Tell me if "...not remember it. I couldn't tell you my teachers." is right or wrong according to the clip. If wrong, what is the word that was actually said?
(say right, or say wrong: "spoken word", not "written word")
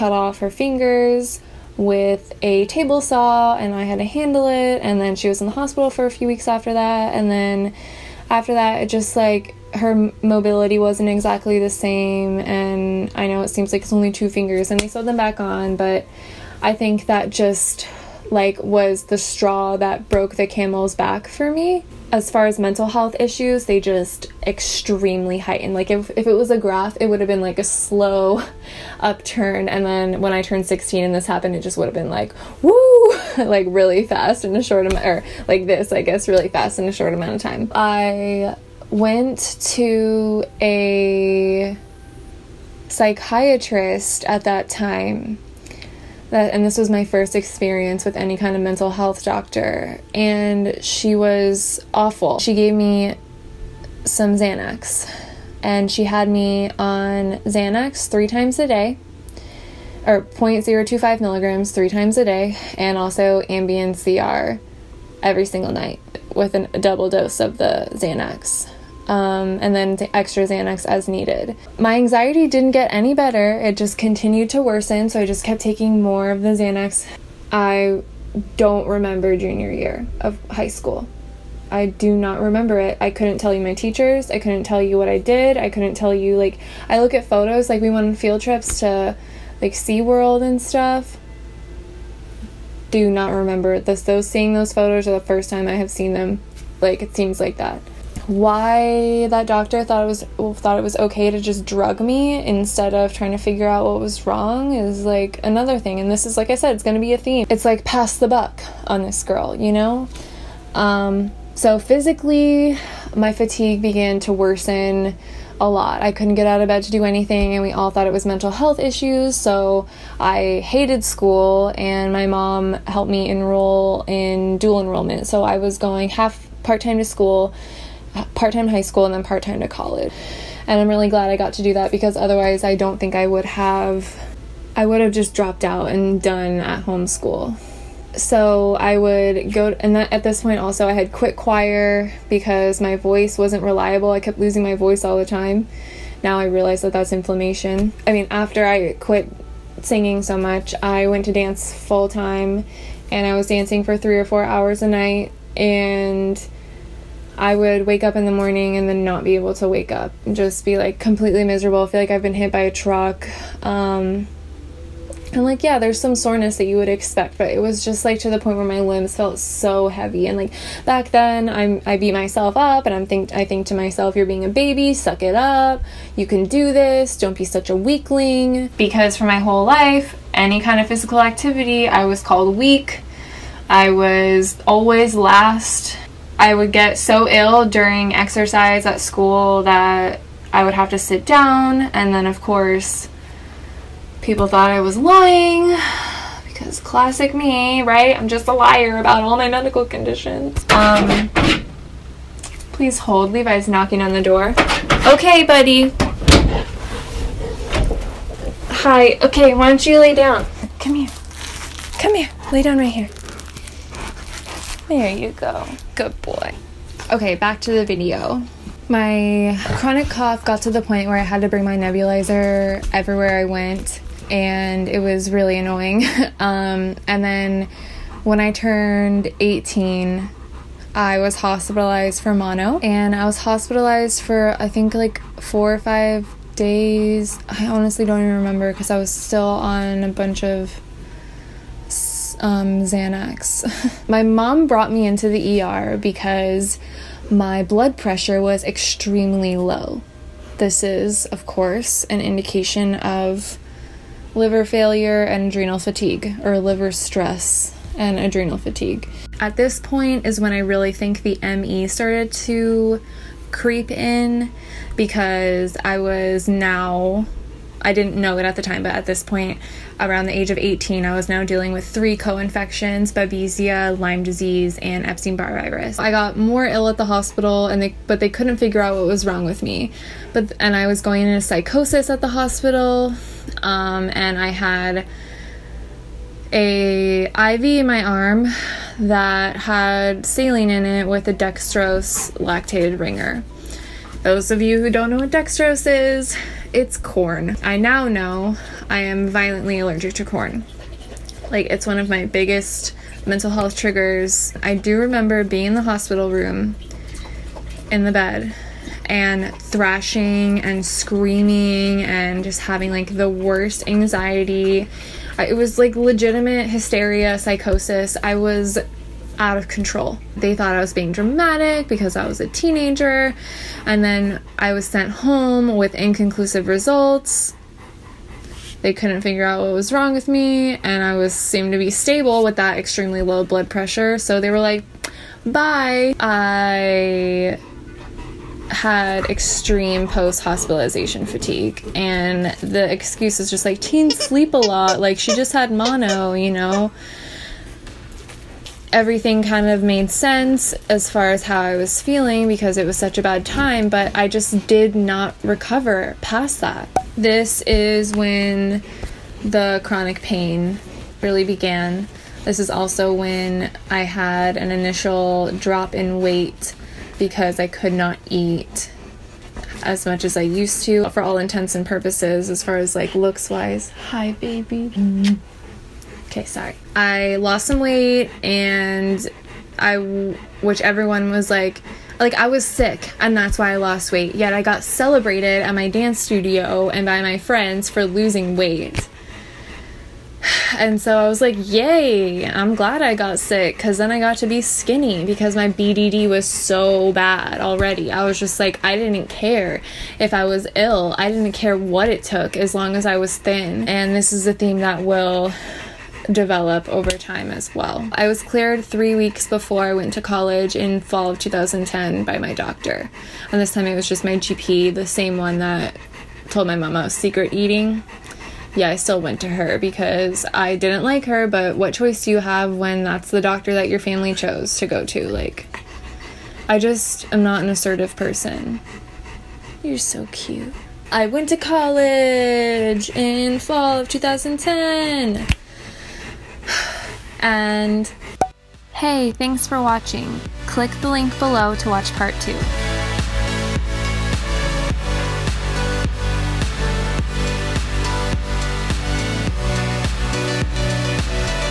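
right.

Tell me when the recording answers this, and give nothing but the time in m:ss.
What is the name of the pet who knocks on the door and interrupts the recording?
3:23.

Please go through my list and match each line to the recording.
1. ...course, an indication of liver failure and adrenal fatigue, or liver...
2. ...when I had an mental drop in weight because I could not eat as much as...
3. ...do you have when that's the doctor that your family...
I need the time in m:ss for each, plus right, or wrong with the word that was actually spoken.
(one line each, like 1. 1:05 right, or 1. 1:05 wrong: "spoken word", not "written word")
1. 4:11 right
2. 6:03 wrong: "initial", not "mental"
3. 7:02 right.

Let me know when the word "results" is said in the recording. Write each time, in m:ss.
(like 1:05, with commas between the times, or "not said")
5:26.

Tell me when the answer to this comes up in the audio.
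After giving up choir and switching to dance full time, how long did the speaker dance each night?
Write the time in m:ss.
2:33.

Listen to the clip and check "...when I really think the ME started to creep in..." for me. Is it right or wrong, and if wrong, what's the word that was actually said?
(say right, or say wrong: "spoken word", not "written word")
right.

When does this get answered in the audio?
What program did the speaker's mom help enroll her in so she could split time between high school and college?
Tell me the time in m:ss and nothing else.
2:04.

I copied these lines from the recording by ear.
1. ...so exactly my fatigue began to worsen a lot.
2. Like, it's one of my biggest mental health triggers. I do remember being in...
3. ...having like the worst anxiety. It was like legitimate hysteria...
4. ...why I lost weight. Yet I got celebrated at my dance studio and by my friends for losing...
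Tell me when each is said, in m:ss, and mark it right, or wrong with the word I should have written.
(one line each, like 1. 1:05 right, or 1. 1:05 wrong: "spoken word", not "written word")
1. 1:51 wrong: "physically", not "exactly"
2. 5:01 right
3. 5:12 right
4. 6:23 right.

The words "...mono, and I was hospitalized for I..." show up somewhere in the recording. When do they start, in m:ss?
3:52.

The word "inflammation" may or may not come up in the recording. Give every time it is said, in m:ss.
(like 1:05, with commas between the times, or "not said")
2:27.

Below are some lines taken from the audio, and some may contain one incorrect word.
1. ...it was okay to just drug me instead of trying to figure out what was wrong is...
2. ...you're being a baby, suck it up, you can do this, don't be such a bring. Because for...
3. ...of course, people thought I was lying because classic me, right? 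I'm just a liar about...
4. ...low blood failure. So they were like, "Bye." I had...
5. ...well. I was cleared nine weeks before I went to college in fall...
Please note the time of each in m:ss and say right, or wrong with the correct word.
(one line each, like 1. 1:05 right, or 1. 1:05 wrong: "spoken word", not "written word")
1. 1:40 right
2. 2:54 wrong: "weakling", not "bring"
3. 3:12 right
4. 5:33 wrong: "pressure", not "failure"
5. 6:47 wrong: "three", not "nine".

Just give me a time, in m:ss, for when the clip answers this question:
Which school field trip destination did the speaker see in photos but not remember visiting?
1:29.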